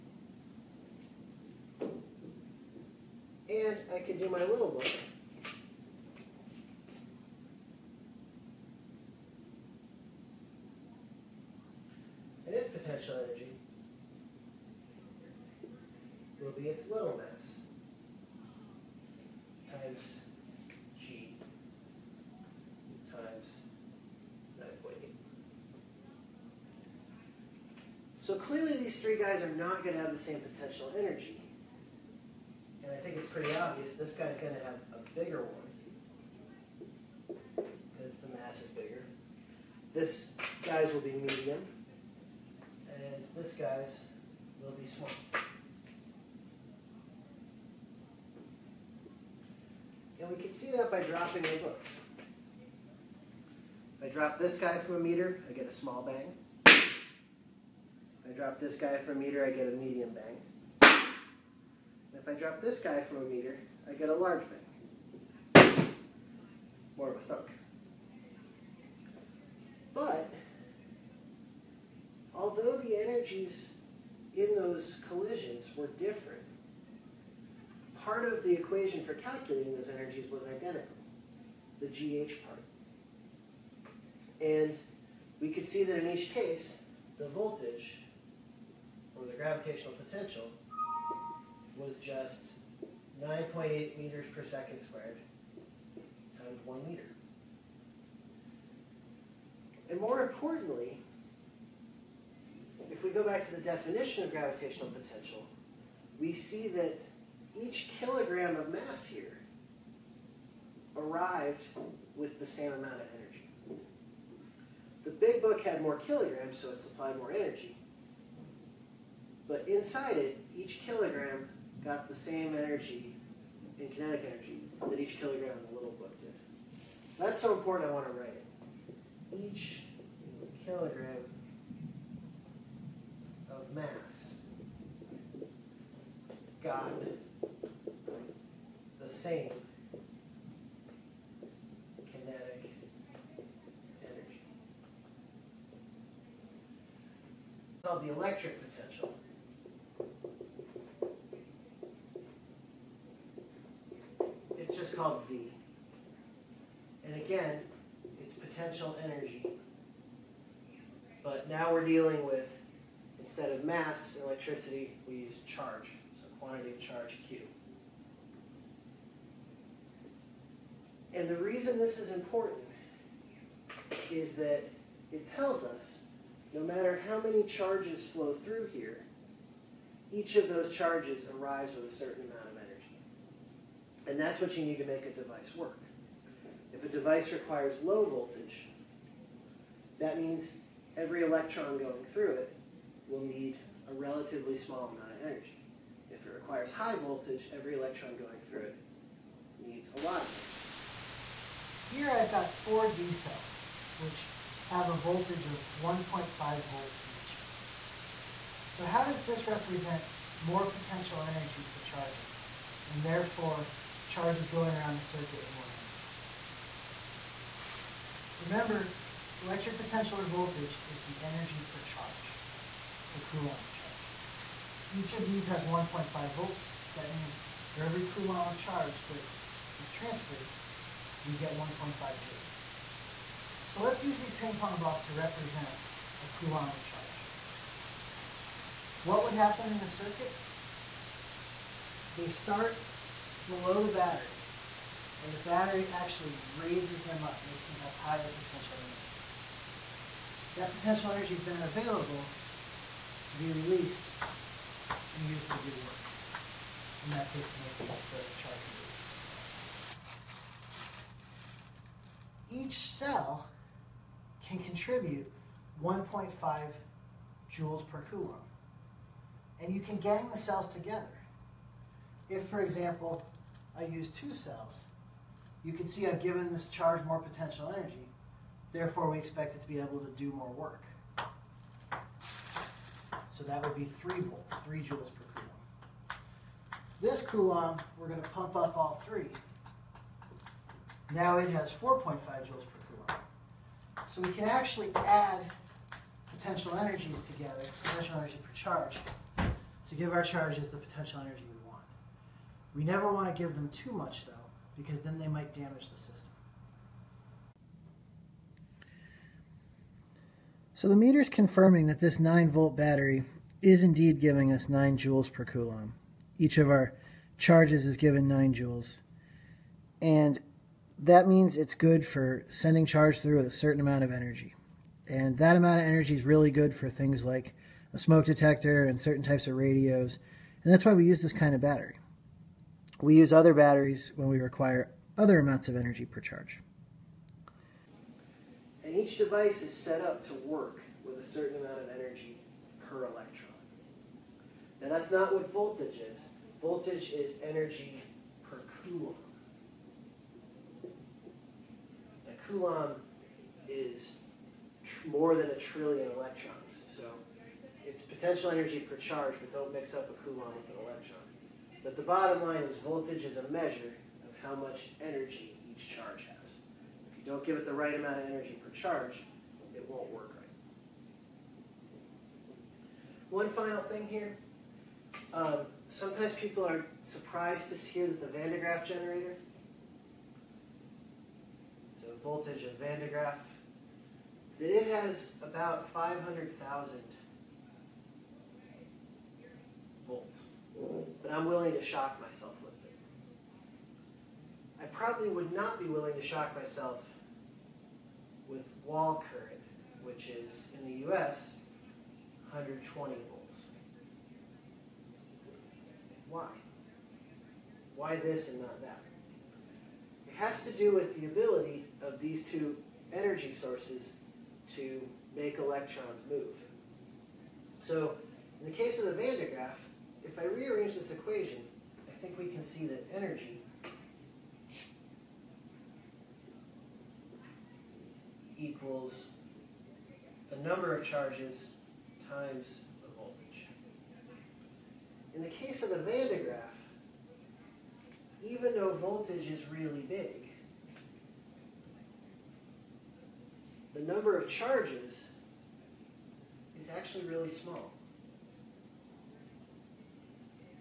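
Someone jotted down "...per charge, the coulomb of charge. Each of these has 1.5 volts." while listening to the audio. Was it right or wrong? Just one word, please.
right.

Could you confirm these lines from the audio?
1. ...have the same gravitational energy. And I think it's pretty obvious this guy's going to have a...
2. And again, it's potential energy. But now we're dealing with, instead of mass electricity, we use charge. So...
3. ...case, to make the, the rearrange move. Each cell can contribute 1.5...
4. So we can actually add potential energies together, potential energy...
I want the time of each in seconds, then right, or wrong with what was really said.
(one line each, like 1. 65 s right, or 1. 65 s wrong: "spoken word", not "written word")
1. 30 s wrong: "potential", not "gravitational"
2. 157 s right
3. 257 s wrong: "charge", not "rearrange"
4. 294 s right.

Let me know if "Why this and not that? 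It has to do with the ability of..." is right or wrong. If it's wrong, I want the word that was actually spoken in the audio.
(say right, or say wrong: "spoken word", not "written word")
right.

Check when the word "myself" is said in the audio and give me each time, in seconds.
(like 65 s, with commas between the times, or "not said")
392 s, 396 s.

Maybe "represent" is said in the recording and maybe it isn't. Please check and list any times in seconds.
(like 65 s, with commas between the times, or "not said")
209 s, 235 s.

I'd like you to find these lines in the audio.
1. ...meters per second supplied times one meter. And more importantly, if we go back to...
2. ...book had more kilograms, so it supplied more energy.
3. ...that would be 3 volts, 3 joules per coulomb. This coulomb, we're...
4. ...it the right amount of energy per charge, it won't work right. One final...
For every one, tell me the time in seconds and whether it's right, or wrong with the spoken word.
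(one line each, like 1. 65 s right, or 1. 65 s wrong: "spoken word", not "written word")
1. 93 s wrong: "squared", not "supplied"
2. 115 s right
3. 283 s right
4. 367 s right.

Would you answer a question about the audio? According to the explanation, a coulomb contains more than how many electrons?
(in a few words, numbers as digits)
a trillion.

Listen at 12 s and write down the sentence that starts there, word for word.
It is potential energy will be its little mass.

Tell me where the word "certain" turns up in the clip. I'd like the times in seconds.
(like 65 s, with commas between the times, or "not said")
181 s, 323 s, 328 s, 341 s.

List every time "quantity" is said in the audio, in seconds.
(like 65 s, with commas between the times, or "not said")
166 s.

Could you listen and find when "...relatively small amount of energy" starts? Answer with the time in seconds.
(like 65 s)
193 s.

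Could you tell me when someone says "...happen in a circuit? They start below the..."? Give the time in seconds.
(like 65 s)
239 s.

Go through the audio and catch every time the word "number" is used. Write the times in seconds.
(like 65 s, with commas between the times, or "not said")
430 s, 444 s.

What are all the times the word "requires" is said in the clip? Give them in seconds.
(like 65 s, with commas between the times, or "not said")
187 s, 196 s, 334 s.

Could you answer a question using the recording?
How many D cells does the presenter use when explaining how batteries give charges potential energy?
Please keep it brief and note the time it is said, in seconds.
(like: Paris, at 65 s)
4, at 202 s.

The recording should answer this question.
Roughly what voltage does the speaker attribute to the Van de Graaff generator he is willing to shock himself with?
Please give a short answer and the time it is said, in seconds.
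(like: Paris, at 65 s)
500,000 volts, at 385 s.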